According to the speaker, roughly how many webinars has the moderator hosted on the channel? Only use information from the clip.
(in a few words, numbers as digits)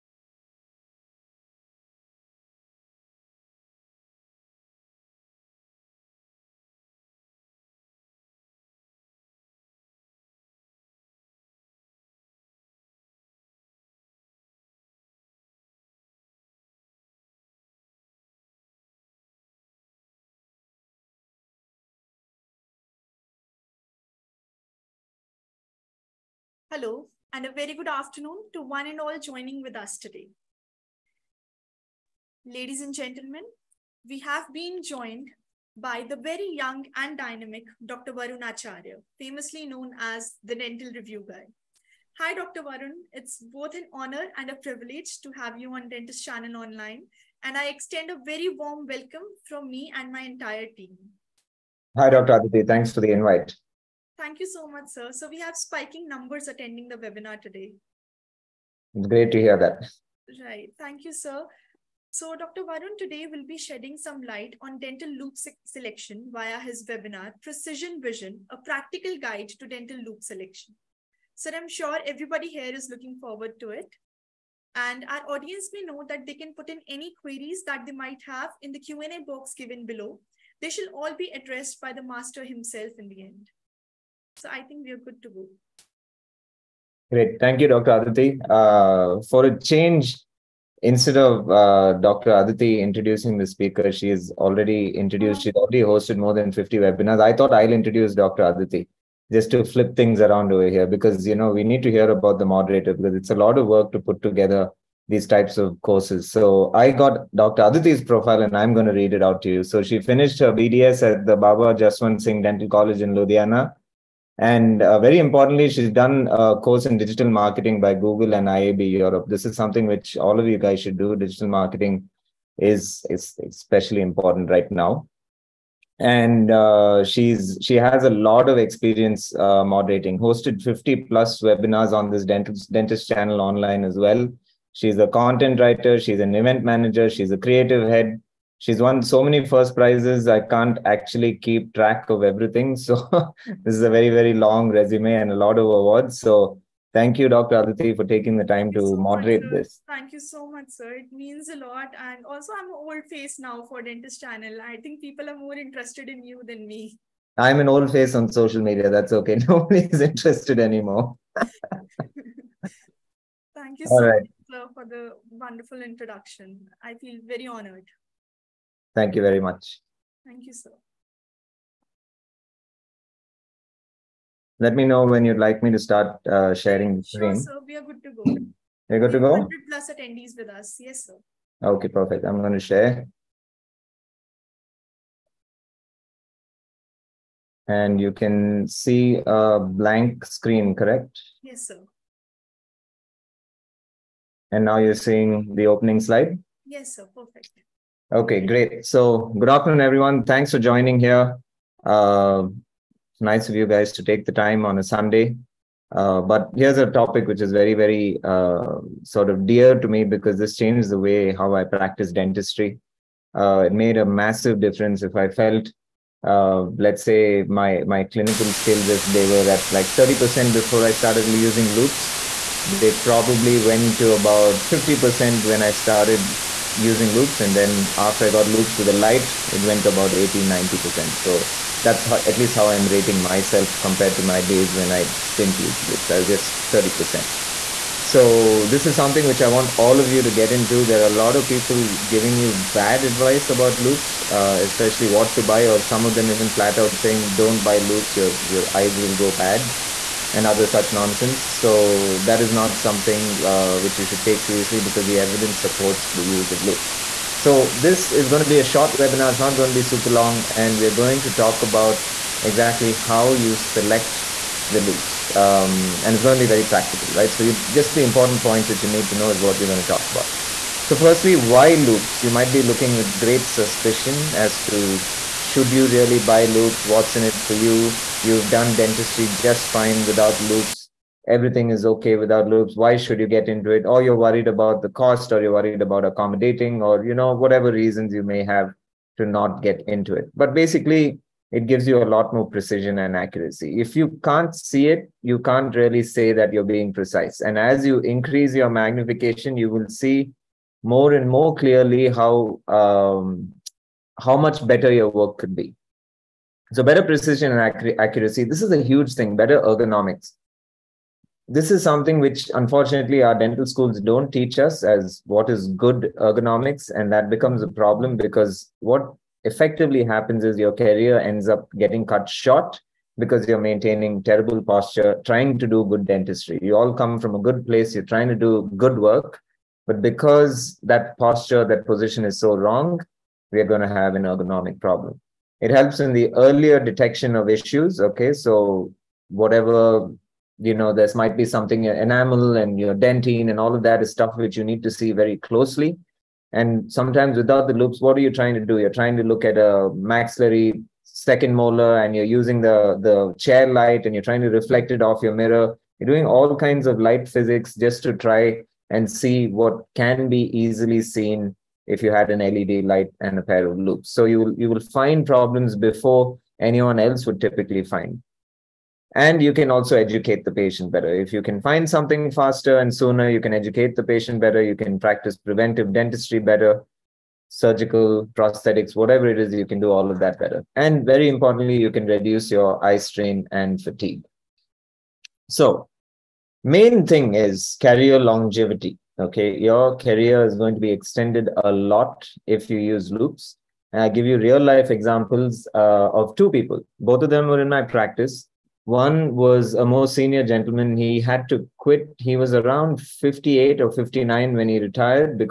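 50 plus.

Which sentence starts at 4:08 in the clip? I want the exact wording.
Your your eyes will go bad." and other such nonsense.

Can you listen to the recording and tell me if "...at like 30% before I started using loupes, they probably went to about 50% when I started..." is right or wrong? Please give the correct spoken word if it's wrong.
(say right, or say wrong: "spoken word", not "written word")
right.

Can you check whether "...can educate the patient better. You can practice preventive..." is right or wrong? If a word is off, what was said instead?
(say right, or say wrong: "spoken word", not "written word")
right.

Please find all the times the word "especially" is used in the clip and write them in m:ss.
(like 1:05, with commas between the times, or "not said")
2:03, 4:04.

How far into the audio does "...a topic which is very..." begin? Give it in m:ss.
3:26.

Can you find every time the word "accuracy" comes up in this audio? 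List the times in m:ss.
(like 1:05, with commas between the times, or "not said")
4:53, 5:07.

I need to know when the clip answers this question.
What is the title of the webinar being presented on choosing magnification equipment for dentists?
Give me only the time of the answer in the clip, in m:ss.
1:07.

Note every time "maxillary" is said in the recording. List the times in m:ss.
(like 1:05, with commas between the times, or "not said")
5:49.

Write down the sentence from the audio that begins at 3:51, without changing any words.
So that's how, at least how I'm rating myself compared to my days when I didn't use loupes.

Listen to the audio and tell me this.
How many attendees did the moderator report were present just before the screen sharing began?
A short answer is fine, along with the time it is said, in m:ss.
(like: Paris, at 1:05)
100 plus, at 2:59.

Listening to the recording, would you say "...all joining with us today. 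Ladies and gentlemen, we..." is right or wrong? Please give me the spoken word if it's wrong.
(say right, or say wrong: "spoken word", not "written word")
right.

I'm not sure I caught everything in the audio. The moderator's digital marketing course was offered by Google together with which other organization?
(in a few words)
IAB Europe.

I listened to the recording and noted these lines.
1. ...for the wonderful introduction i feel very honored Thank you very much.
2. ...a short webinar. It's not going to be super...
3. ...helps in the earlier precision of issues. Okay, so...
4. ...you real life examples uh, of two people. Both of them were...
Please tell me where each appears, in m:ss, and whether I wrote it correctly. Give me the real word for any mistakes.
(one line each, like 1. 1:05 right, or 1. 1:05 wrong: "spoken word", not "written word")
1. 2:44 right
2. 4:18 right
3. 5:35 wrong: "detection", not "precision"
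4. 6:34 right.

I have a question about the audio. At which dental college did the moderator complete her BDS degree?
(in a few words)
Baba Jaswant Singh Dental College.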